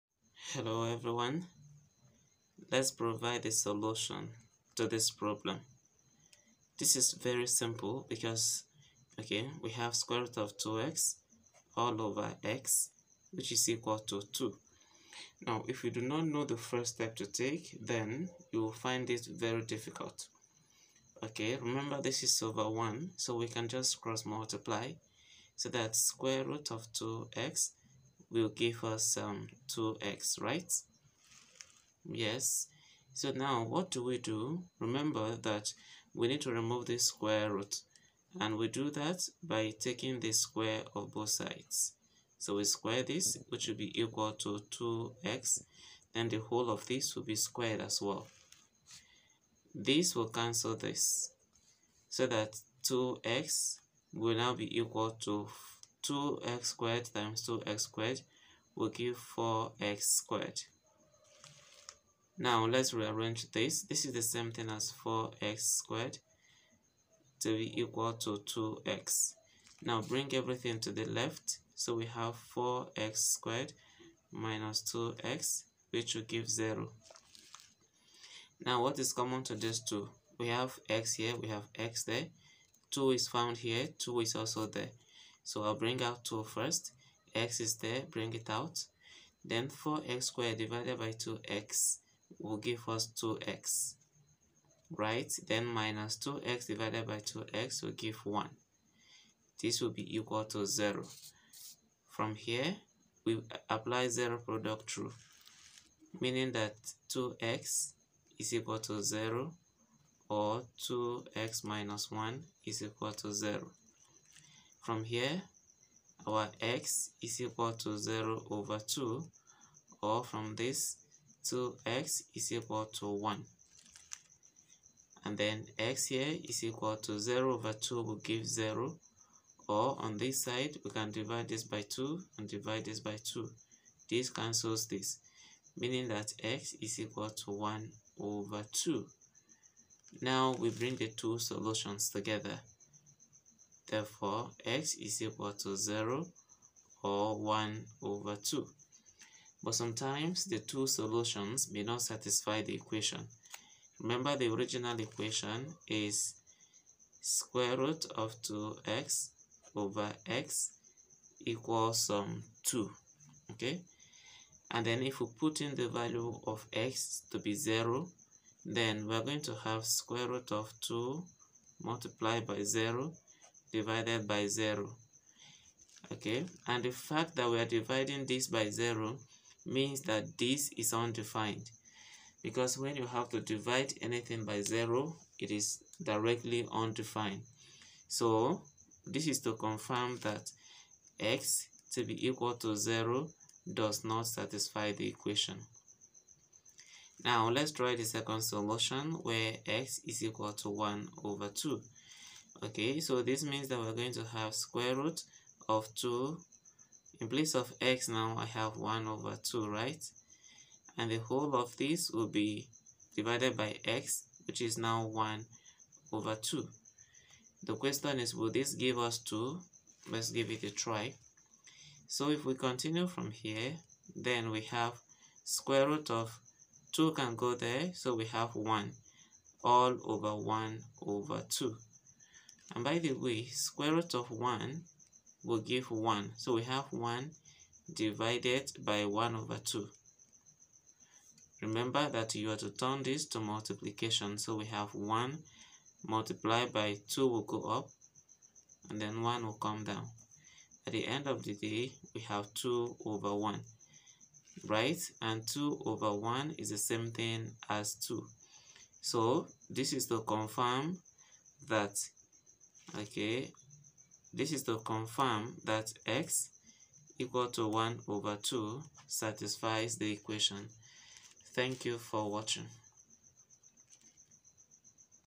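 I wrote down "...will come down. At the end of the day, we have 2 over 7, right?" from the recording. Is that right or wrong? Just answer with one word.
wrong.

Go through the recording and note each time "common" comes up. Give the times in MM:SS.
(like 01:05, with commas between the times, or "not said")
01:19.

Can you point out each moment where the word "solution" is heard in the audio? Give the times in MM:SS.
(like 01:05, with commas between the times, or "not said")
00:03, 02:21, 02:30, 03:18.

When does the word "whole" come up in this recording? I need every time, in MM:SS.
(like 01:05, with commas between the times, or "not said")
00:46, 03:31.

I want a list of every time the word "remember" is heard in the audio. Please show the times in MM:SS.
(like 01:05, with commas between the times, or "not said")
00:21, 00:34, 02:33, 04:01.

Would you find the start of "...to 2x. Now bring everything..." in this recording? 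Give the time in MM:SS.
01:08.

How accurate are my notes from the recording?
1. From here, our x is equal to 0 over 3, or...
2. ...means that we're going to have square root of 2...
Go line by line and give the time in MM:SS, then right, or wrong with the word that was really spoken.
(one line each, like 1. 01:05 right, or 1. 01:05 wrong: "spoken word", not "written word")
1. 01:54 wrong: "2", not "3"
2. 03:23 right.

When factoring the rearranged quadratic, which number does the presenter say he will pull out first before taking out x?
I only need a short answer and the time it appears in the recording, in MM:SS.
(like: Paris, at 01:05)
2, at 01:25.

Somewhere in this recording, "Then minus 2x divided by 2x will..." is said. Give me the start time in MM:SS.
01:35.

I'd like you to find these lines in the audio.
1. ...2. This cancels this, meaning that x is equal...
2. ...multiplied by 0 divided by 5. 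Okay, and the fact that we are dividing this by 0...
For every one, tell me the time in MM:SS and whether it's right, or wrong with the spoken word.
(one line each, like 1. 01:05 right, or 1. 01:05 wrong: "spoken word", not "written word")
1. 02:13 right
2. 02:51 wrong: "0", not "5".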